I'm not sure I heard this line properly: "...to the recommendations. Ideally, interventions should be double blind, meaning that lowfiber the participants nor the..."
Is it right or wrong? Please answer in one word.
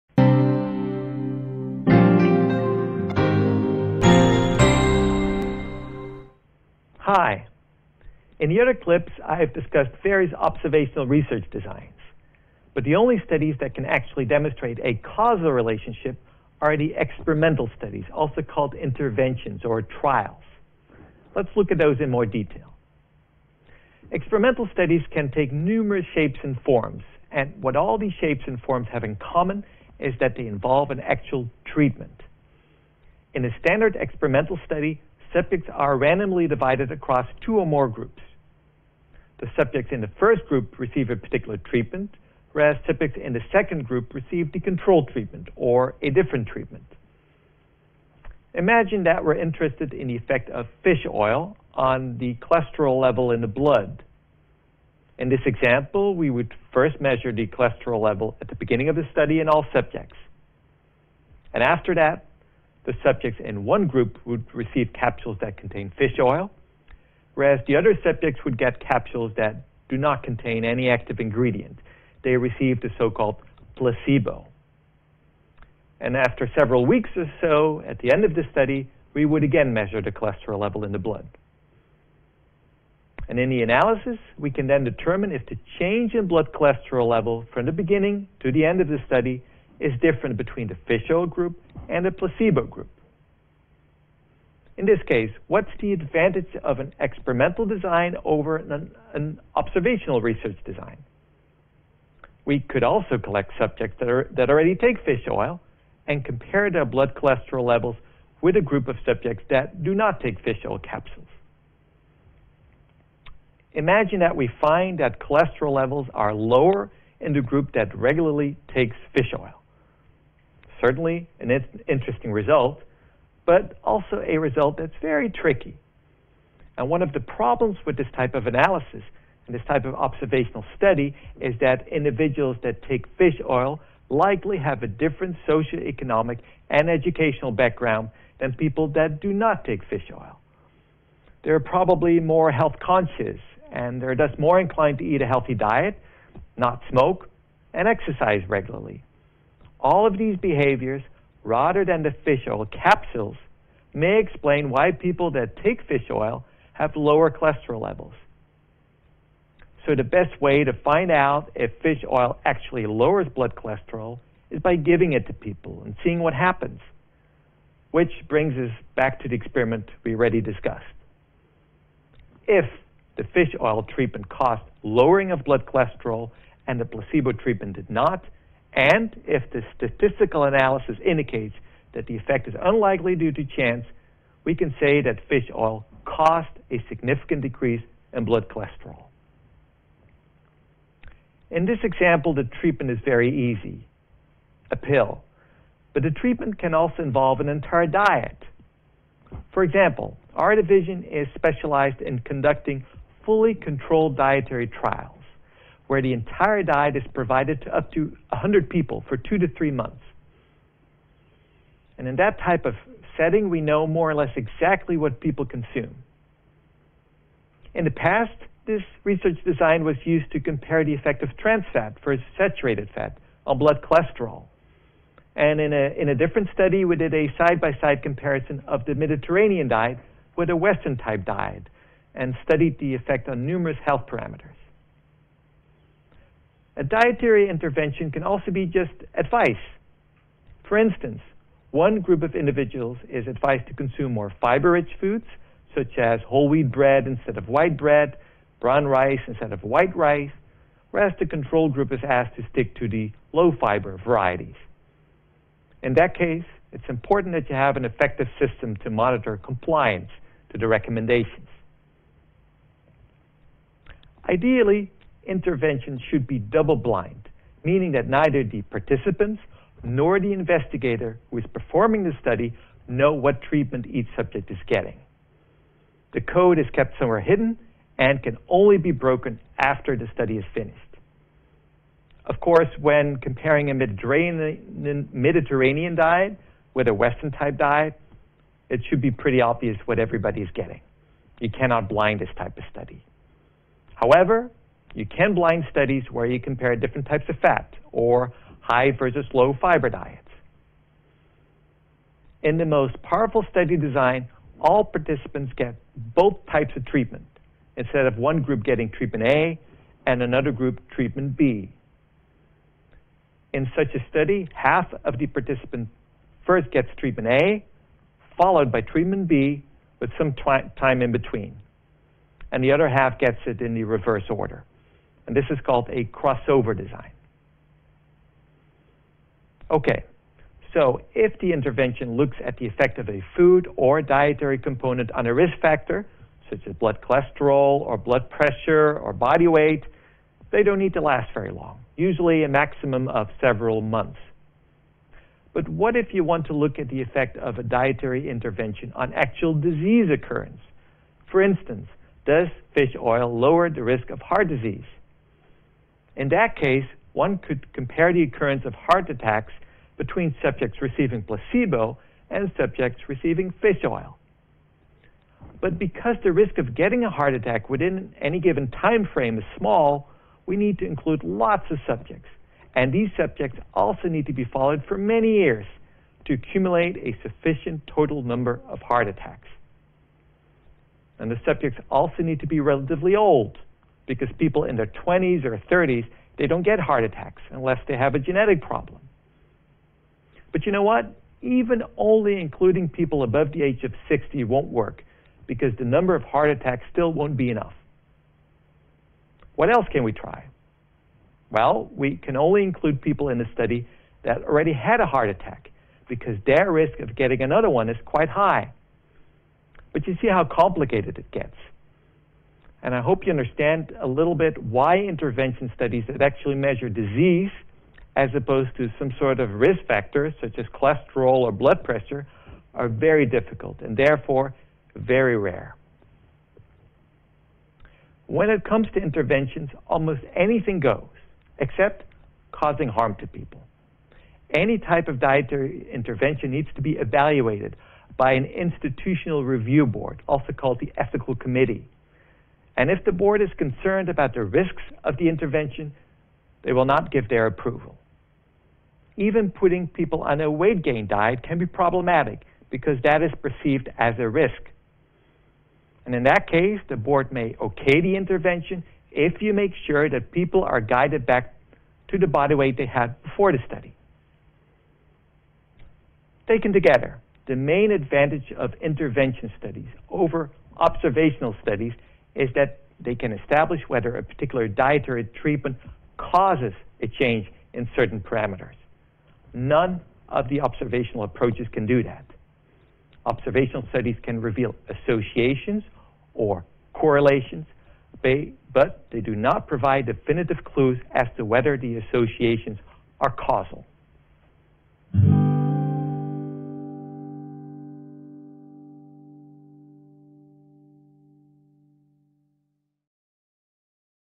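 wrong.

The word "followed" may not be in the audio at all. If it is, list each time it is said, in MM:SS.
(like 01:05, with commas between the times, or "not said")
05:18, 06:14.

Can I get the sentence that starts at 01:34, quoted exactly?
In this case, what's the advantage of an experimental design over an, an observational research design?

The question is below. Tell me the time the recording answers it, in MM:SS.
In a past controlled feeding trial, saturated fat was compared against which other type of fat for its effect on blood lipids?
03:41.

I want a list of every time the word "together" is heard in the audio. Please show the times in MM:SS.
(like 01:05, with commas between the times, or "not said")
07:46.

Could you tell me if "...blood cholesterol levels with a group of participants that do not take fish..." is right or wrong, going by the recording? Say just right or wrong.
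wrong.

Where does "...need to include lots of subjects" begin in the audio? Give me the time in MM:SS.
06:10.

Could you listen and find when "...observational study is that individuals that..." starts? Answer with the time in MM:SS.
02:09.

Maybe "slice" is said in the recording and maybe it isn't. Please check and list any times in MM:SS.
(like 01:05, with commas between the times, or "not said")
not said.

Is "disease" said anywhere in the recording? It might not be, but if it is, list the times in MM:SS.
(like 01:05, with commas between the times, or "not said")
05:49, 05:54, 06:56.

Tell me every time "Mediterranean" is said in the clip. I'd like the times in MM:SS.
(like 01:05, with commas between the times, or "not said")
03:48, 04:43.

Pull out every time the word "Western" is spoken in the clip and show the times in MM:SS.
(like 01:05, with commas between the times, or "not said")
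03:50, 04:46.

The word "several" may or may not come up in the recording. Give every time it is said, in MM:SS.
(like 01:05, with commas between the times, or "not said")
01:16, 05:43.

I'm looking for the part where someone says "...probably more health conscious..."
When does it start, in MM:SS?
02:21.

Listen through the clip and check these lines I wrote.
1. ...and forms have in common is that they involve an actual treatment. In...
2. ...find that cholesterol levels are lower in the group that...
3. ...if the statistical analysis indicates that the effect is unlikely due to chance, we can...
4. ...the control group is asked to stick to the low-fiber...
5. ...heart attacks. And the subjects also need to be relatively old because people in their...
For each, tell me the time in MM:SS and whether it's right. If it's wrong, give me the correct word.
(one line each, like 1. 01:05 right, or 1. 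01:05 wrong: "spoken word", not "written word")
1. 00:28 right
2. 01:54 right
3. 02:59 right
4. 04:11 right
5. 06:18 right.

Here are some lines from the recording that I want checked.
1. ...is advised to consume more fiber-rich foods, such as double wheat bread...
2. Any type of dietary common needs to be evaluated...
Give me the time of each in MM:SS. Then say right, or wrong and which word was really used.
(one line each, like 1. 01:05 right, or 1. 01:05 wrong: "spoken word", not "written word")
1. 04:03 wrong: "whole", not "double"
2. 07:14 wrong: "intervention", not "common".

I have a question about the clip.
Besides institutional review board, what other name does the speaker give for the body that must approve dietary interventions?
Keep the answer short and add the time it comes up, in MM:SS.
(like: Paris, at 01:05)
ethical committee, at 07:20.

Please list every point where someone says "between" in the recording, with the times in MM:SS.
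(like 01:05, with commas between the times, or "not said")
01:30, 05:21, 05:59.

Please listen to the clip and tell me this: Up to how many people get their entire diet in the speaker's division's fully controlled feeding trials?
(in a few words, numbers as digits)
100.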